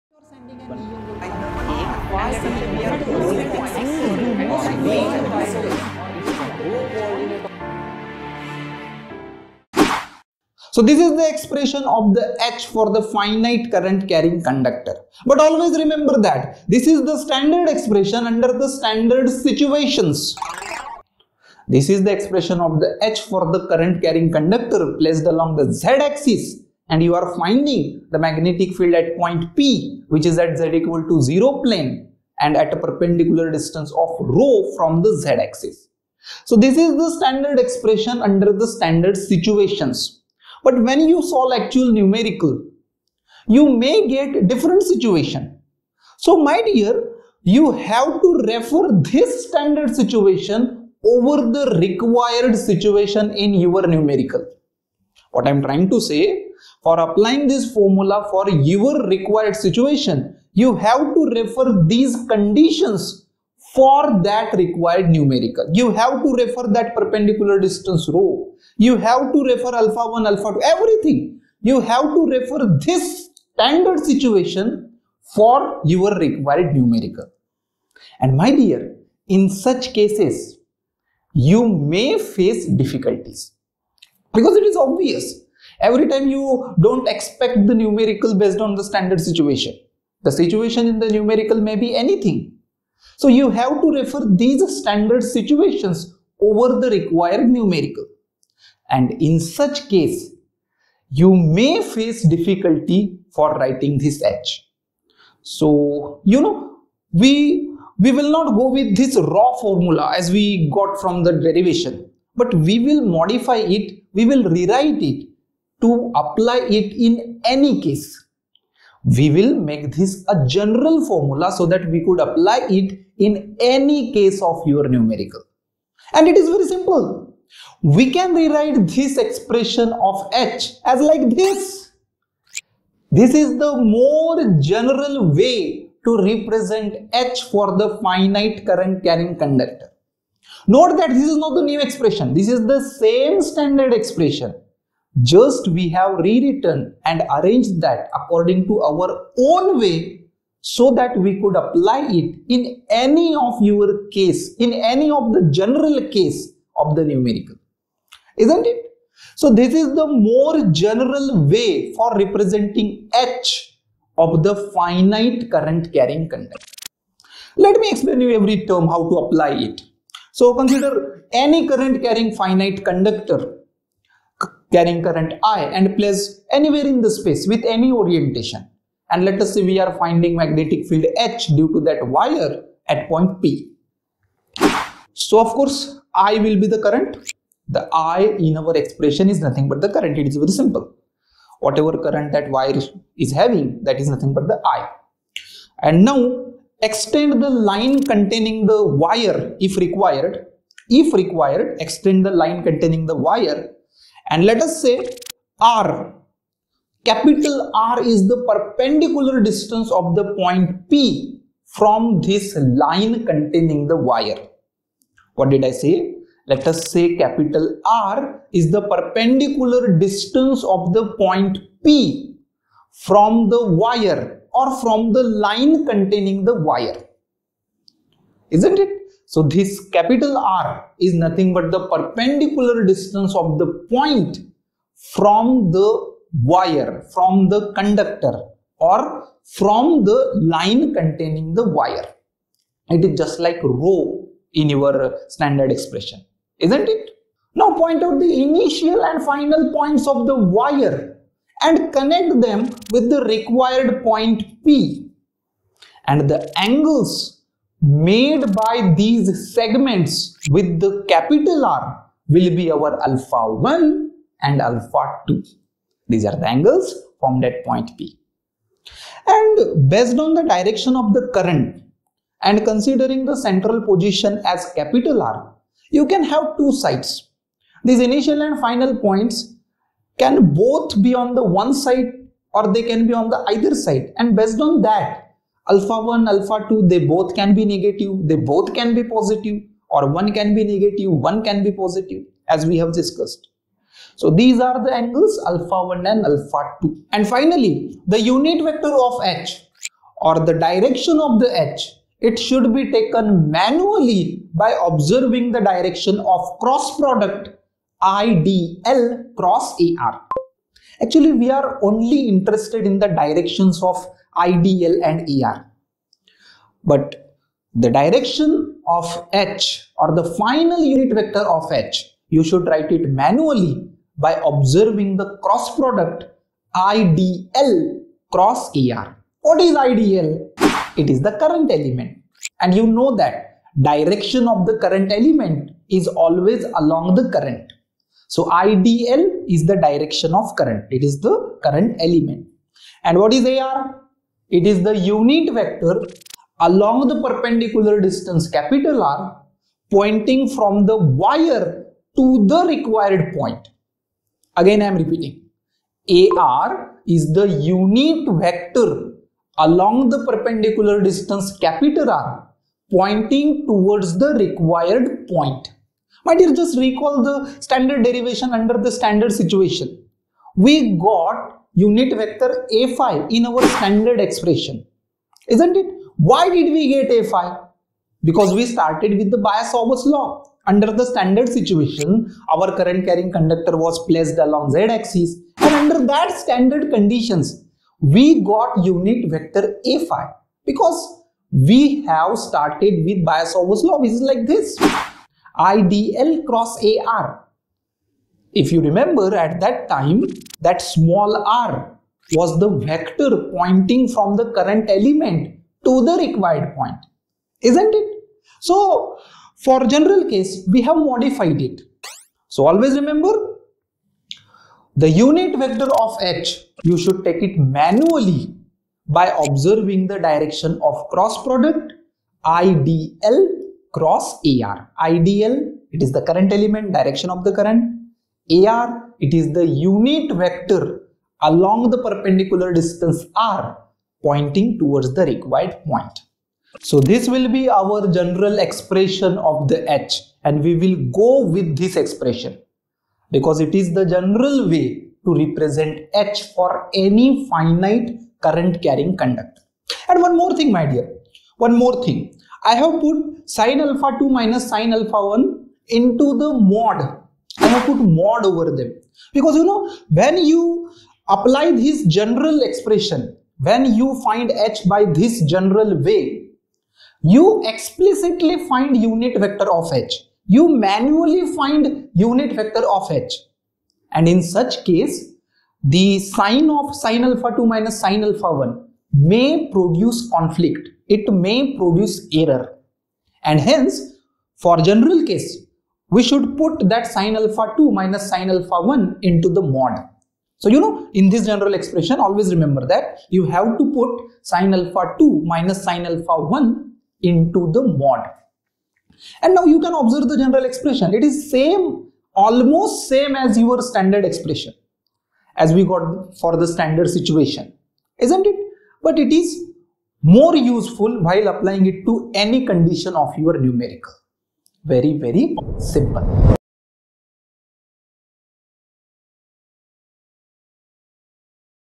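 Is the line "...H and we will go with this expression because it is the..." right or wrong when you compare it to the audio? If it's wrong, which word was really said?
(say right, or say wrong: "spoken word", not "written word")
right.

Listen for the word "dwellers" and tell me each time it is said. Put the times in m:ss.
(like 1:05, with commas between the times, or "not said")
not said.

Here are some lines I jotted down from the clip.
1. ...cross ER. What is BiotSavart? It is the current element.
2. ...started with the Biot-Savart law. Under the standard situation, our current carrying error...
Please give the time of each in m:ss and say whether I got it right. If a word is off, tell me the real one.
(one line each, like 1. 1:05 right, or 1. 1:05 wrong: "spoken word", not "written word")
1. 5:28 wrong: "IDL", not "BiotSavart"
2. 6:18 wrong: "conductor", not "error".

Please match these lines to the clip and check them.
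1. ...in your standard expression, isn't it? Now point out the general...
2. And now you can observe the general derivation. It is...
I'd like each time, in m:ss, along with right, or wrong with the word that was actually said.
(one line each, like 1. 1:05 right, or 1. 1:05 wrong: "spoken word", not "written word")
1. 4:04 wrong: "initial", not "general"
2. 8:19 wrong: "expression", not "derivation".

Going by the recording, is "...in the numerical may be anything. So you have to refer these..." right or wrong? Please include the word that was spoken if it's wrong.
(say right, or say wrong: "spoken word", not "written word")
right.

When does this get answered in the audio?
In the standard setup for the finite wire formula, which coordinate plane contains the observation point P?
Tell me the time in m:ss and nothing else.
0:30.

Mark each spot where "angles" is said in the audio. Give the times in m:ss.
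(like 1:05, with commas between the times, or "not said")
4:16, 4:26, 4:55.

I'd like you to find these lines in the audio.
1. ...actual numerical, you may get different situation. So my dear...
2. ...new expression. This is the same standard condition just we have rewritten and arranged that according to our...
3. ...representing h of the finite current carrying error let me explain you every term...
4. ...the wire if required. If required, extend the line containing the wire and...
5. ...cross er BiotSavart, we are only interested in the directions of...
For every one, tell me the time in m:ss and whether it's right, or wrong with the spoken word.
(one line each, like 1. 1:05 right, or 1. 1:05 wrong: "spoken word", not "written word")
1. 0:41 right
2. 2:21 wrong: "expression", not "condition"
3. 2:42 wrong: "conductor", not "error"
4. 3:18 right
5. 5:09 wrong: "Actually", not "BiotSavart".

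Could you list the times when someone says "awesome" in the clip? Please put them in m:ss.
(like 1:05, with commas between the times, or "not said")
not said.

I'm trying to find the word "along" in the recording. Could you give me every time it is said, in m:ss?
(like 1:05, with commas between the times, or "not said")
0:25, 5:36, 5:46, 5:59, 6:24, 7:11.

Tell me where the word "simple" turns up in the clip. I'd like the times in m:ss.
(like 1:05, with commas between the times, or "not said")
2:06, 3:10, 8:35.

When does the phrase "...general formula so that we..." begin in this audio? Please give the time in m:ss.
2:00.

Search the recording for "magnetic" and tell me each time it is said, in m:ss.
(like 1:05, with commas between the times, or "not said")
0:28, 3:00.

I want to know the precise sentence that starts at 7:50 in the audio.
You manually find unit vector of h.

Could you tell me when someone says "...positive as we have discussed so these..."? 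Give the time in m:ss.
4:51.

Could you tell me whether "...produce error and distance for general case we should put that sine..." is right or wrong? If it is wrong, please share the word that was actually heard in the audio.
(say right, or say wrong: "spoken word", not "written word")
wrong: "hence", not "distance".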